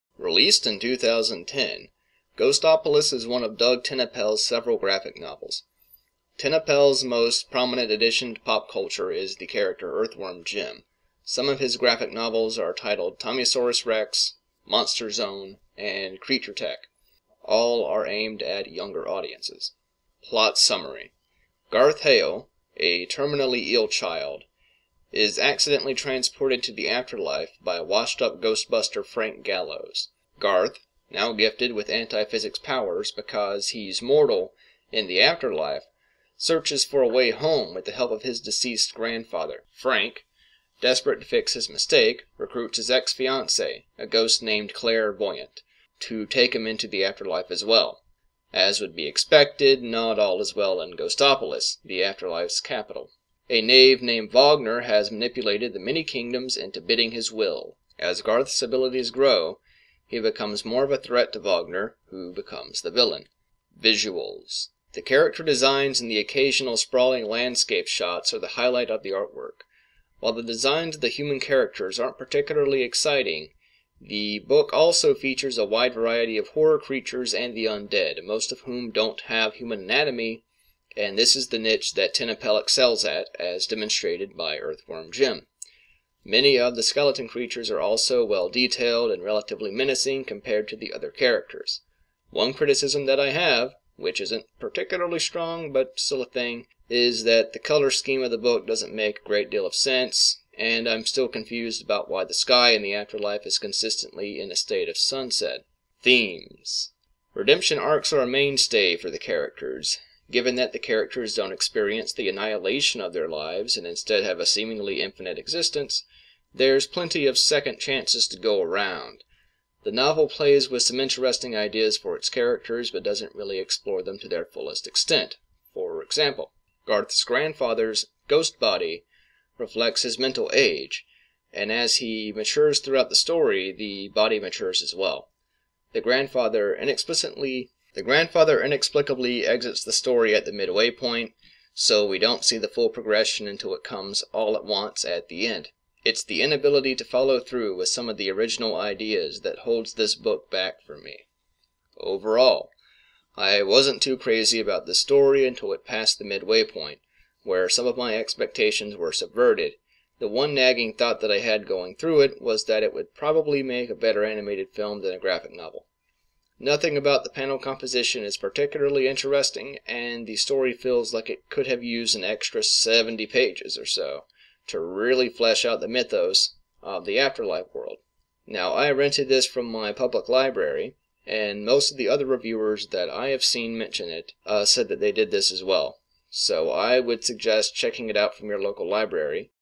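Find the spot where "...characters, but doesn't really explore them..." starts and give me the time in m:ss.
2:02.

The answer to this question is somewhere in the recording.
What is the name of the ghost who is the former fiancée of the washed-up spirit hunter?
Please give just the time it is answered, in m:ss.
0:44.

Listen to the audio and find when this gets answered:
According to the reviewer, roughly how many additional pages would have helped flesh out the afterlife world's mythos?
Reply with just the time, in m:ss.
2:52.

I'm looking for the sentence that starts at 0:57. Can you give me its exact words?
As Garth's abilities grow, he becomes more of a threat to Wagner, who becomes the villain.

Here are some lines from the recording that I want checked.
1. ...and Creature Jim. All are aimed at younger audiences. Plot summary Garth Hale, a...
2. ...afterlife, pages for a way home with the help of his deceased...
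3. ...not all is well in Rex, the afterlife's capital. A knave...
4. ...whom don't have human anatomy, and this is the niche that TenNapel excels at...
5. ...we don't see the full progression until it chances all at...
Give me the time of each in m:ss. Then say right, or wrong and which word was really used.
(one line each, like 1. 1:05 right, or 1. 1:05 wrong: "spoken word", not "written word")
1. 0:15 wrong: "Tech", not "Jim"
2. 0:35 wrong: "searches", not "pages"
3. 0:49 wrong: "Ghostopolis", not "Rex"
4. 1:18 right
5. 2:22 wrong: "comes", not "chances".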